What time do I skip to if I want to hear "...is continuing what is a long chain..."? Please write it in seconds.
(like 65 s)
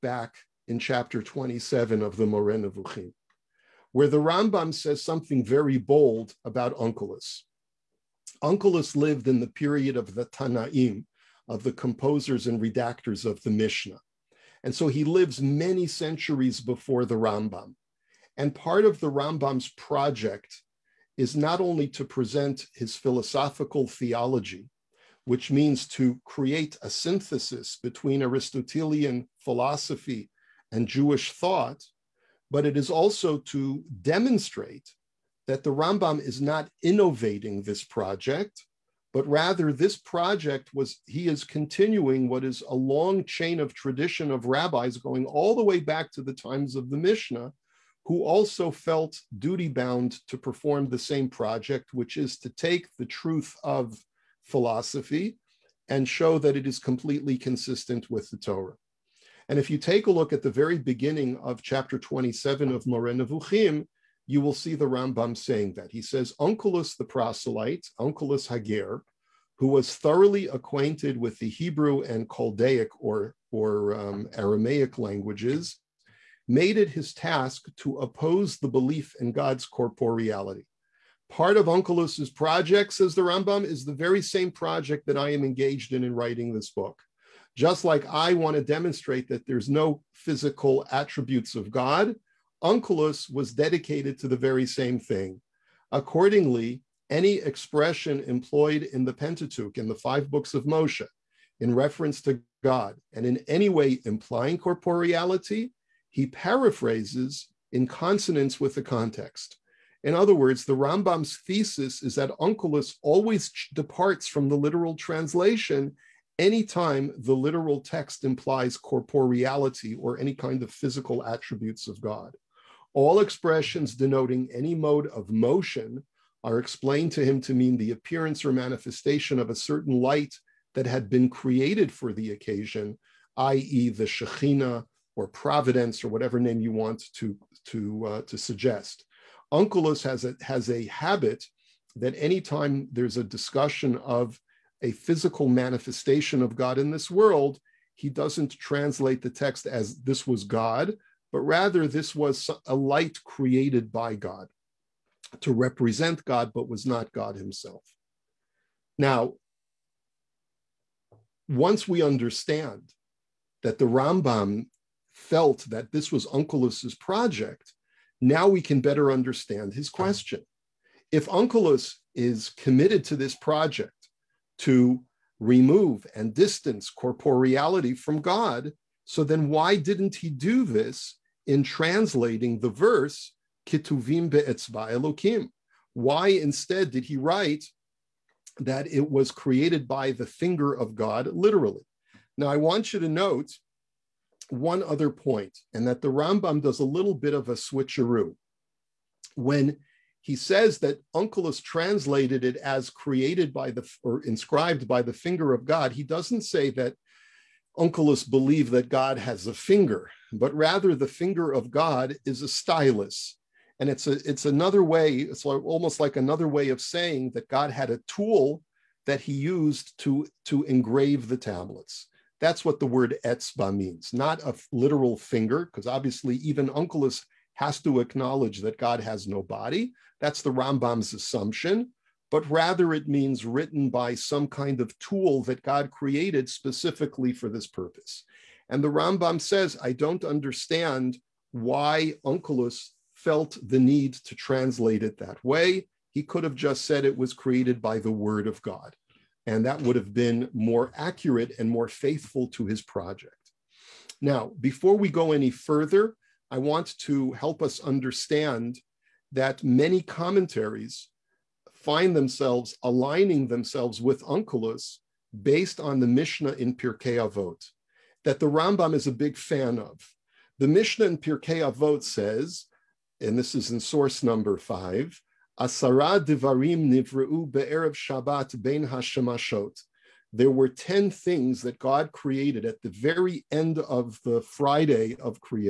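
41 s.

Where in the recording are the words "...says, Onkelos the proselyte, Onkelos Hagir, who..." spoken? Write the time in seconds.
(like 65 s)
66 s.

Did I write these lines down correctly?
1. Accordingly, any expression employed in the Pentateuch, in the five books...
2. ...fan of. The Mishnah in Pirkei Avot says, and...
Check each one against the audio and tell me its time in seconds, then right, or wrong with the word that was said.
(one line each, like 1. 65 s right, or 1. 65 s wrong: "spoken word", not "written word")
1. 95 s right
2. 269 s right.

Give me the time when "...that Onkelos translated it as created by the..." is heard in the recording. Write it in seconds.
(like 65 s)
200 s.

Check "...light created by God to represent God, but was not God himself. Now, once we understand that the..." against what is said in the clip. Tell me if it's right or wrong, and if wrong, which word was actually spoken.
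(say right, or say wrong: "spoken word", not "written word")
right.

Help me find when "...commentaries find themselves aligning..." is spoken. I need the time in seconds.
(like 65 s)
260 s.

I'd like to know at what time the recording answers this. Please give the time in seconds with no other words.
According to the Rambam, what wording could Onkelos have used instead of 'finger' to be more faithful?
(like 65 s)
247 s.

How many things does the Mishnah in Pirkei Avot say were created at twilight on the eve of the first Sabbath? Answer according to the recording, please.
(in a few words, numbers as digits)
10.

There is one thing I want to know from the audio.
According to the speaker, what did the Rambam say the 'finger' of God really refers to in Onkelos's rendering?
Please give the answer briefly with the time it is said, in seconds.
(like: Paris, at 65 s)
A stylus, at 212 s.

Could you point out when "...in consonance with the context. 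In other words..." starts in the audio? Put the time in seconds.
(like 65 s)
107 s.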